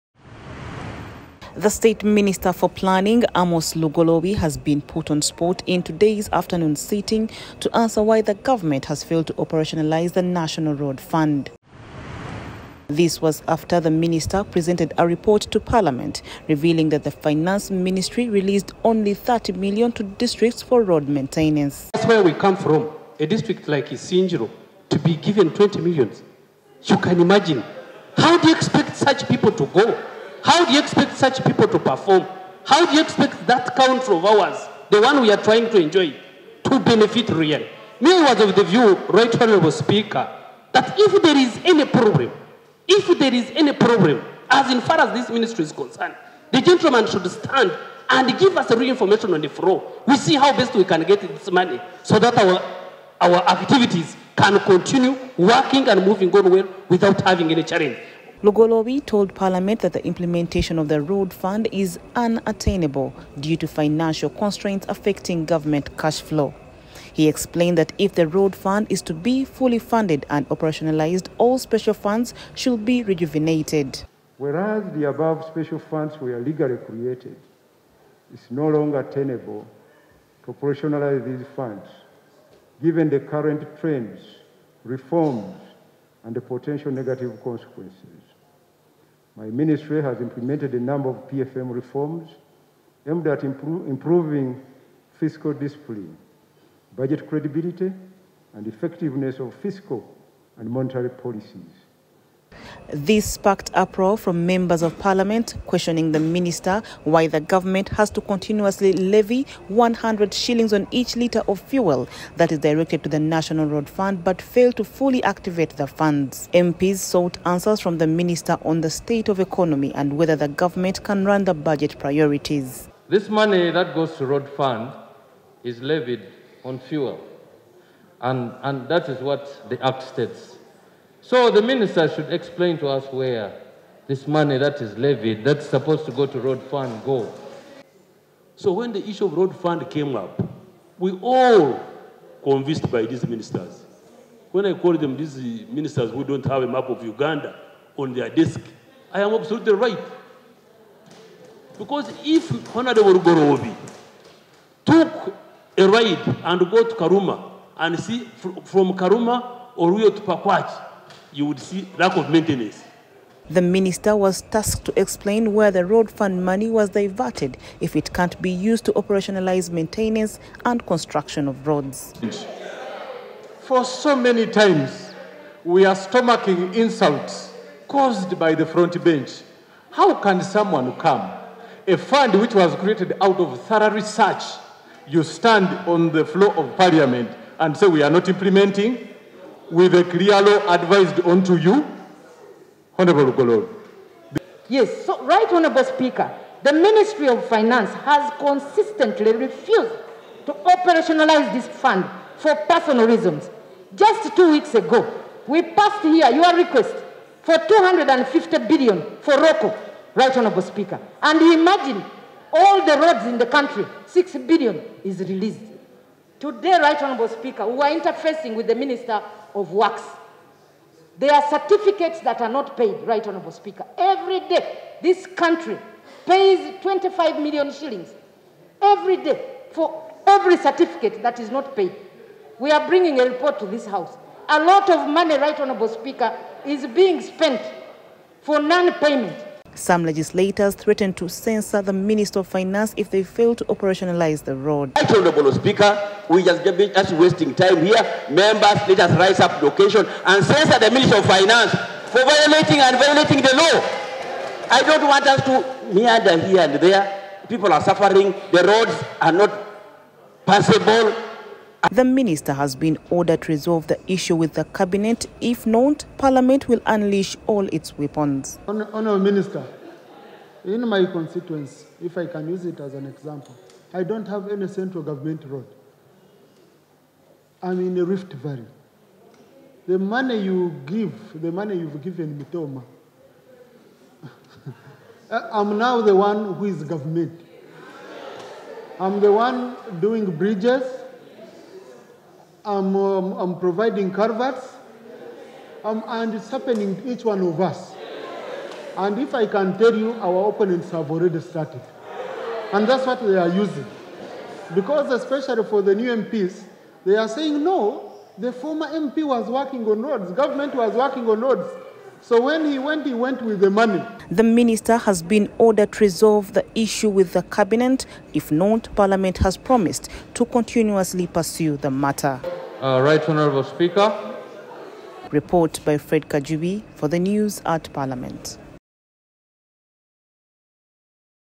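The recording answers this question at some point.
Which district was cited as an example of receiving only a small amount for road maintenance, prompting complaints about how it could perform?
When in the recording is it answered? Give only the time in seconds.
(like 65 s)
23 s.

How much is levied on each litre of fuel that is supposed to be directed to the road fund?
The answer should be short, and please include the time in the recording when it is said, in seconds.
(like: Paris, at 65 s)
100 shillings, at 109 s.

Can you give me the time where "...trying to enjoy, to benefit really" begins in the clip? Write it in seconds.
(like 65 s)
35 s.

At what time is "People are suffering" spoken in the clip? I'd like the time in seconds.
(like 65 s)
257 s.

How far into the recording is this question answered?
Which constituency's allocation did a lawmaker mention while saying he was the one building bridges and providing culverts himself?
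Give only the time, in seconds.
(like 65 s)
282 s.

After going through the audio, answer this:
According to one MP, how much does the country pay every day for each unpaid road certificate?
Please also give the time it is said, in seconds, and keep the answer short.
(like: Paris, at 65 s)
25 million shillings, at 226 s.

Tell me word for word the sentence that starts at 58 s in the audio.
Lugolobi told Parliament that the implementation of the road fund is unattainable due to financial constraints affecting government cash flow.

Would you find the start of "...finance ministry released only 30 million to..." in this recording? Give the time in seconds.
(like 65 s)
17 s.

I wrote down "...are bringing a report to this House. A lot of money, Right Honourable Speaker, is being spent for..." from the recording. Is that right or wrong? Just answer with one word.
right.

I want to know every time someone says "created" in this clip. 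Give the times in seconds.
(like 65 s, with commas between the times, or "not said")
76 s, 182 s.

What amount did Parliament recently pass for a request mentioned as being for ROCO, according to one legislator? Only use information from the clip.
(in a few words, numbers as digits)
250 billion.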